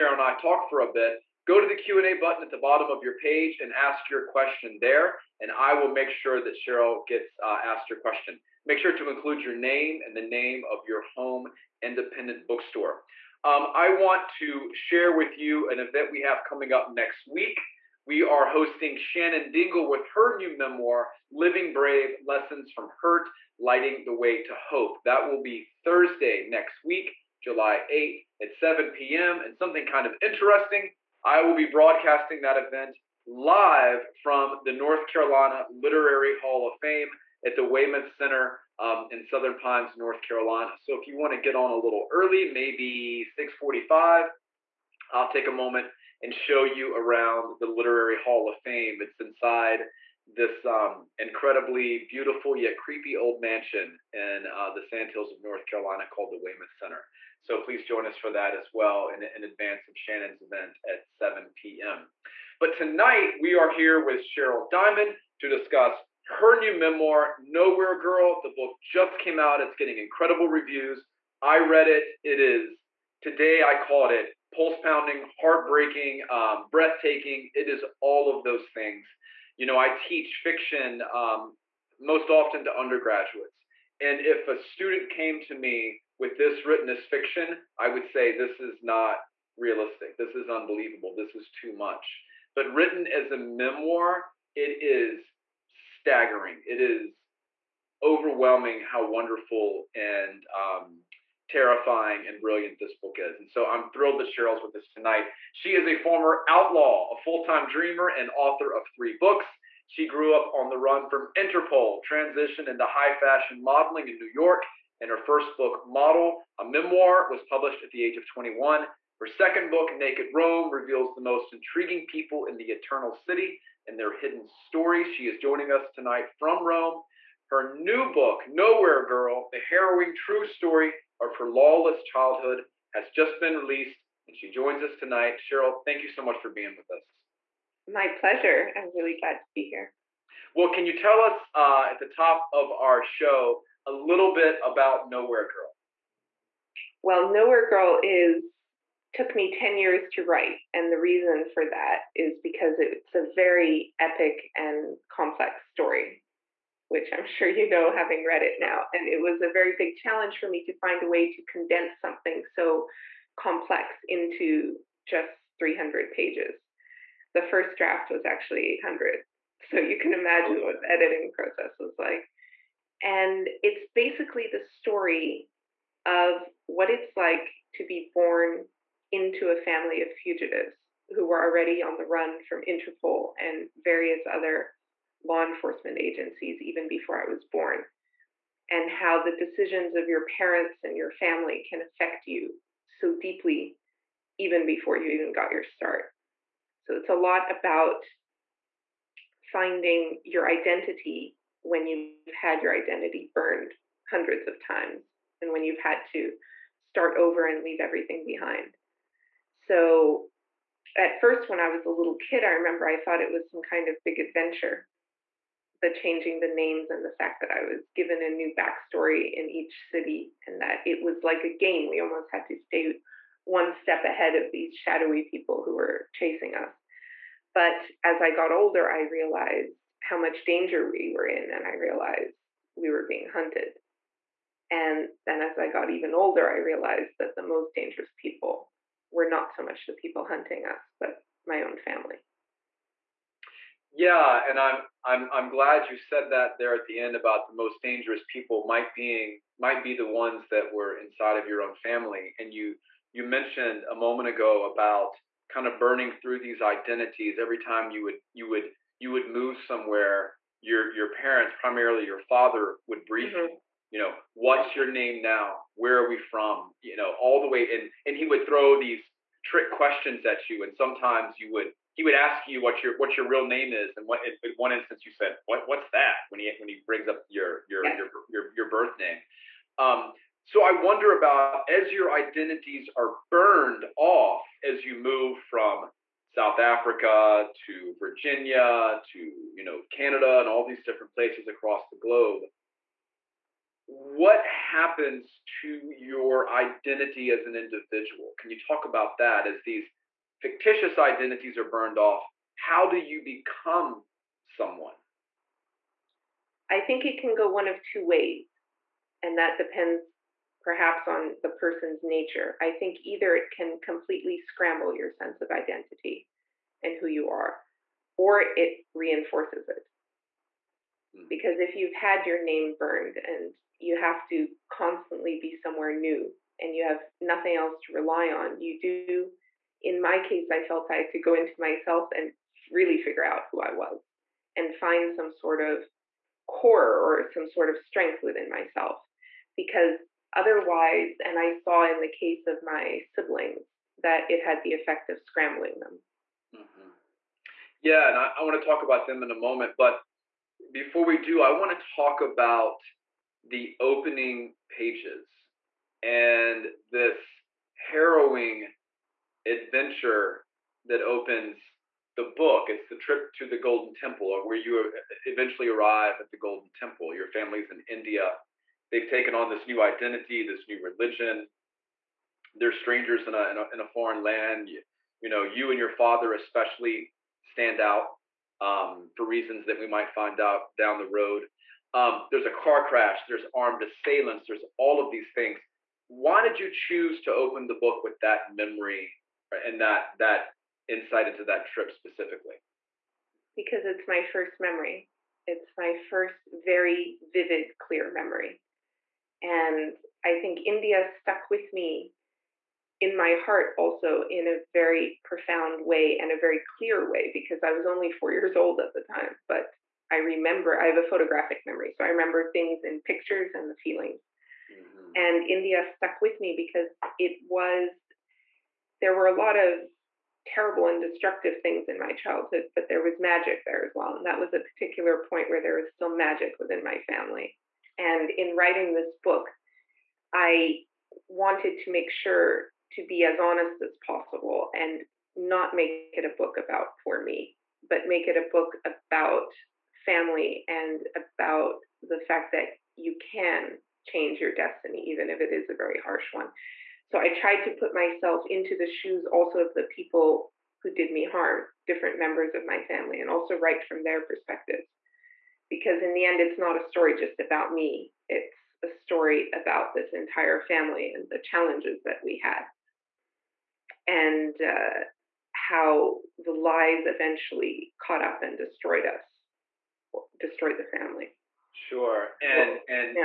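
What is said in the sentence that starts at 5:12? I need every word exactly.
I think either it can completely scramble your sense of identity and who you are, or it reinforces it.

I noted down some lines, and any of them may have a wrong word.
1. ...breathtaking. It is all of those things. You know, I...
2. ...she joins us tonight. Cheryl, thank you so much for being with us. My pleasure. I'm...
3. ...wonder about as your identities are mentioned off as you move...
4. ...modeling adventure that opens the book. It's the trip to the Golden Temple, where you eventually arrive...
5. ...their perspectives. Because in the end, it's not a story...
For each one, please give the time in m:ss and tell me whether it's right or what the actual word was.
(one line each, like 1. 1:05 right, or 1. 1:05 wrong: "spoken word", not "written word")
1. 1:16 right
2. 2:14 right
3. 4:40 wrong: "burned", not "mentioned"
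4. 5:57 wrong: "harrowing", not "modeling"
5. 7:34 right.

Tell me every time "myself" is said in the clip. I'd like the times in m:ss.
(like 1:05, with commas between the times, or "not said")
5:31, 5:38, 7:27.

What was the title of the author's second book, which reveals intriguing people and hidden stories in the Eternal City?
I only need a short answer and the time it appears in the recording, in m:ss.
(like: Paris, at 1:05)
Naked Rome, at 1:59.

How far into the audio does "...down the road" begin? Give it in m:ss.
6:20.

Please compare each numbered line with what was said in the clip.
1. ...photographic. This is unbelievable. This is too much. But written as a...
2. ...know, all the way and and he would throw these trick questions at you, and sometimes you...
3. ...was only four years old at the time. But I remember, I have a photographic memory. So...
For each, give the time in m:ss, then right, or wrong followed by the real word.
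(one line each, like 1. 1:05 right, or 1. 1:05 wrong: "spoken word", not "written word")
1. 1:29 wrong: "realistic", not "photographic"
2. 4:26 right
3. 6:47 right.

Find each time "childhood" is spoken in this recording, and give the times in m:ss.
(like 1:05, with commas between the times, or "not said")
2:12, 7:02.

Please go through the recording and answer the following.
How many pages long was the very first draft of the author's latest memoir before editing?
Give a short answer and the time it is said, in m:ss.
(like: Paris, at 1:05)
800, at 2:48.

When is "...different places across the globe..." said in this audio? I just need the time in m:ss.
4:50.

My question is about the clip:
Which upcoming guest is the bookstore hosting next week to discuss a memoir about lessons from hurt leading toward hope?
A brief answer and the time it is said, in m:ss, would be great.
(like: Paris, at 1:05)
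Shannon Dingle, at 0:18.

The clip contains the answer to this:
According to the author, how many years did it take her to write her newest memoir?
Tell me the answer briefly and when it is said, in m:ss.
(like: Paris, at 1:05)
10, at 2:29.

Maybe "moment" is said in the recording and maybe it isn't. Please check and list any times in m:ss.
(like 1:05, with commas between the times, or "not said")
0:45, 4:13, 5:49.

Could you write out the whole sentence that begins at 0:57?
So please join us for that as well in, in advance of Shannon's event at 7 p.m.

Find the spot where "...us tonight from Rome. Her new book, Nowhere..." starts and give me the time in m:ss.
2:05.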